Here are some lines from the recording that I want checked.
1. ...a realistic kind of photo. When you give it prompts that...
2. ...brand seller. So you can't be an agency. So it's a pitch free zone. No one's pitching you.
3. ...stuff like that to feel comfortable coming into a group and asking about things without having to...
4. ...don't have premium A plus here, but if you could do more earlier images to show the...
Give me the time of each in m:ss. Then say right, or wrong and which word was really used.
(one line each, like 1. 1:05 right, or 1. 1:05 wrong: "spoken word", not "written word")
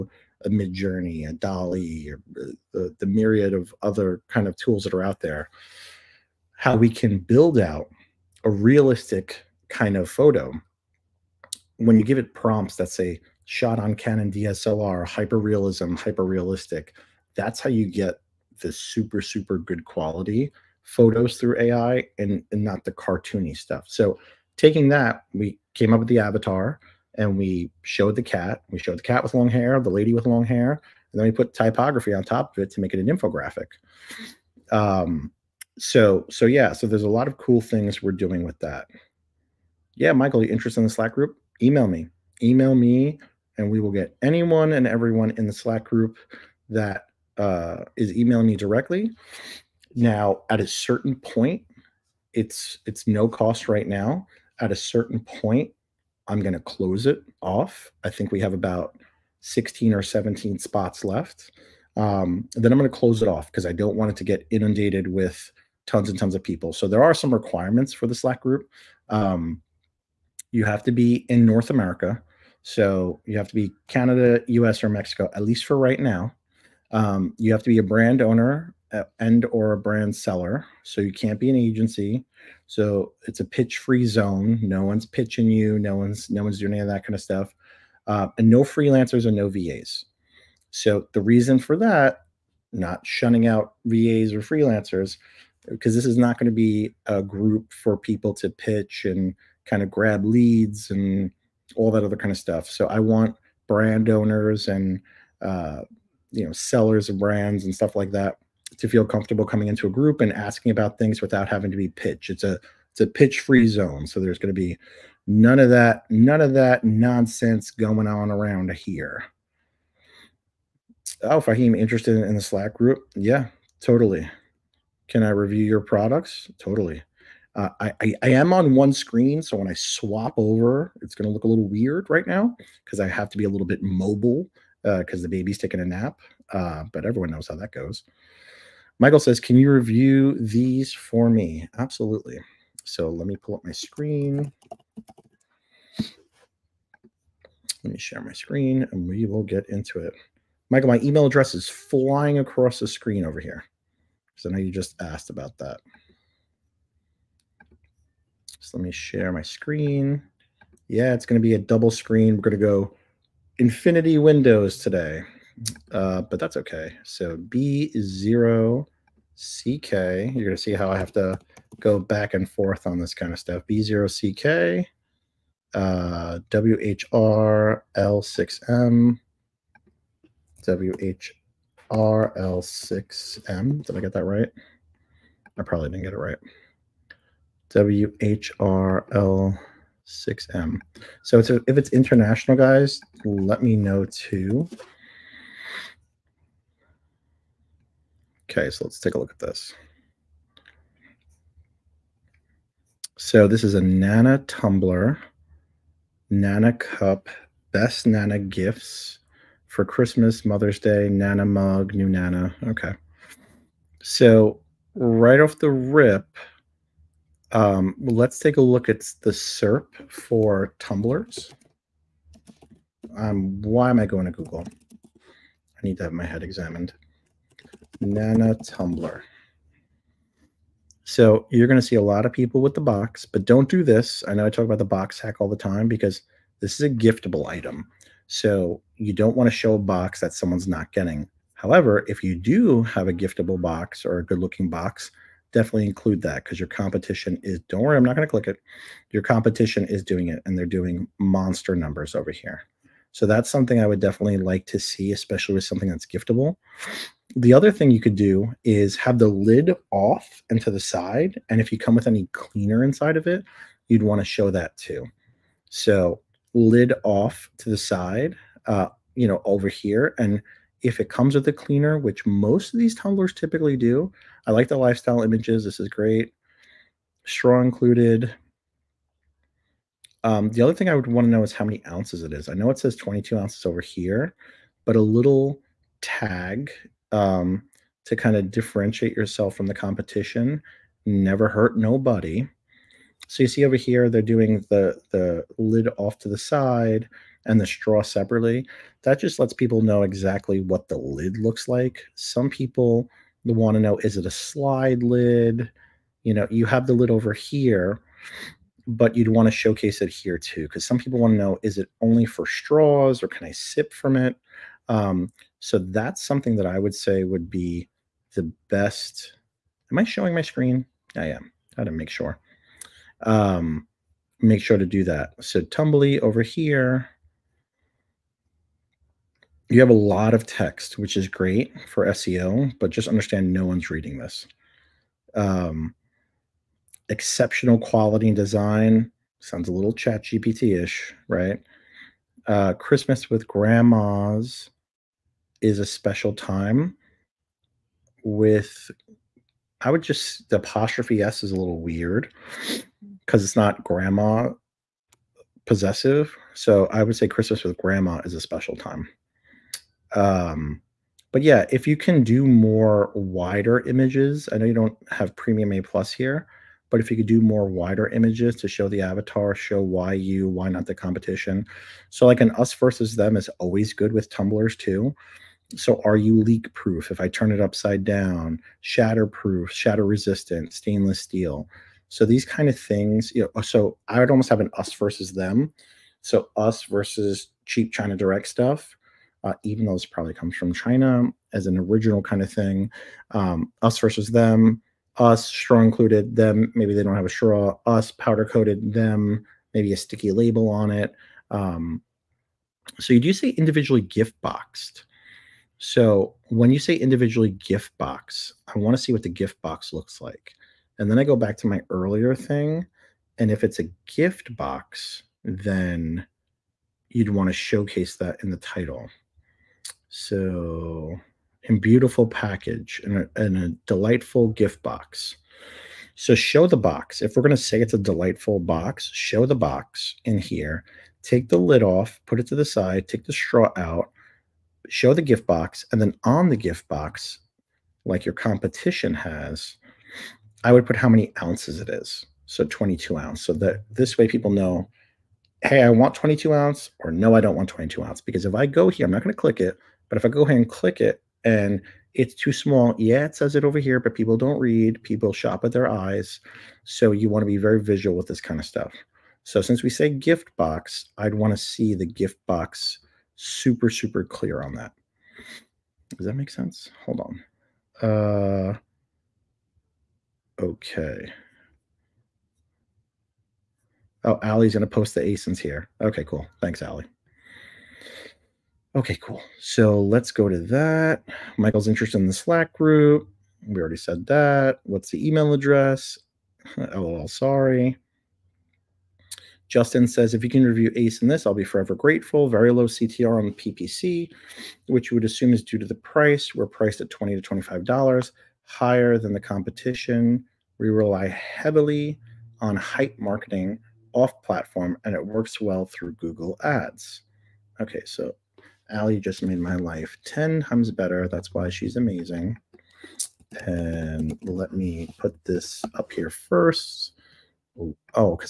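1. 0:08 right
2. 1:19 right
3. 1:47 right
4. 6:04 wrong: "wider", not "earlier".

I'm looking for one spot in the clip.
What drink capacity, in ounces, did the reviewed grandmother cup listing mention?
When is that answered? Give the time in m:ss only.
4:42.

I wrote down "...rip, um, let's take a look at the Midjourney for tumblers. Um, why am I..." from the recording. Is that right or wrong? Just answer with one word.
wrong.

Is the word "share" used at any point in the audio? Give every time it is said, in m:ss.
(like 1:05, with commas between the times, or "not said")
2:27, 2:38.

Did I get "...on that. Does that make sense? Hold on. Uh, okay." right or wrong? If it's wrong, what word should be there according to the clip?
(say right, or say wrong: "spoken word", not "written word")
right.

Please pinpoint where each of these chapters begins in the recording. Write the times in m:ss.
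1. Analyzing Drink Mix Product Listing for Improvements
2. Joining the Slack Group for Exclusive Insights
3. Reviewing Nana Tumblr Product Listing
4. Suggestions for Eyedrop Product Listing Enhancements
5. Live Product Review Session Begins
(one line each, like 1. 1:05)
1. 8:08
2. 0:46
3. 2:27
4. 5:31
5. 2:06.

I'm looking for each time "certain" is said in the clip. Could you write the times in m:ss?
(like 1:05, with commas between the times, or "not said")
0:50, 0:54.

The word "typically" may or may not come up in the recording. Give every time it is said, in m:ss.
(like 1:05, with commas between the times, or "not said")
4:33.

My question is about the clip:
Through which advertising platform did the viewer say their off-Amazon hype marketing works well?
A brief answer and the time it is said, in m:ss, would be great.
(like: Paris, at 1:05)
Google Ads, at 8:26.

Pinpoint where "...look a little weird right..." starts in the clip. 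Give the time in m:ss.
2:11.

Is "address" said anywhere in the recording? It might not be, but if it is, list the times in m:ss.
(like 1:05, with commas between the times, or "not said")
2:31, 8:05.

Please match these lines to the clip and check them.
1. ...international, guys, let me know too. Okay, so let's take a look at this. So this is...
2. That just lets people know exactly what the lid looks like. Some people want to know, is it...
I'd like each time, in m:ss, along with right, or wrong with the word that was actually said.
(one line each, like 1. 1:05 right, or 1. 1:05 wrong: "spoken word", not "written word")
1. 3:11 right
2. 4:59 right.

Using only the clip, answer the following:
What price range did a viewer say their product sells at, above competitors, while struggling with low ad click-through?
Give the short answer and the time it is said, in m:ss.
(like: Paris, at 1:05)
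$20 to $25, at 8:17.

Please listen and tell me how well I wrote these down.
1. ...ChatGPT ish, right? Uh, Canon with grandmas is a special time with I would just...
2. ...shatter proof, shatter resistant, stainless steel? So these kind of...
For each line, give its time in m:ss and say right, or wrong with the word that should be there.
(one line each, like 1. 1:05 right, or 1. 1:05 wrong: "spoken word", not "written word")
1. 5:39 wrong: "Christmas", not "Canon"
2. 6:18 right.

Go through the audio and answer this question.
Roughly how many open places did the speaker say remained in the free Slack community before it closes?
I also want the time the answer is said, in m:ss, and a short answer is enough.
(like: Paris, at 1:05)
16 or 17, at 0:59.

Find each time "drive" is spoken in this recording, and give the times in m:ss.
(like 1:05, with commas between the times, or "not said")
not said.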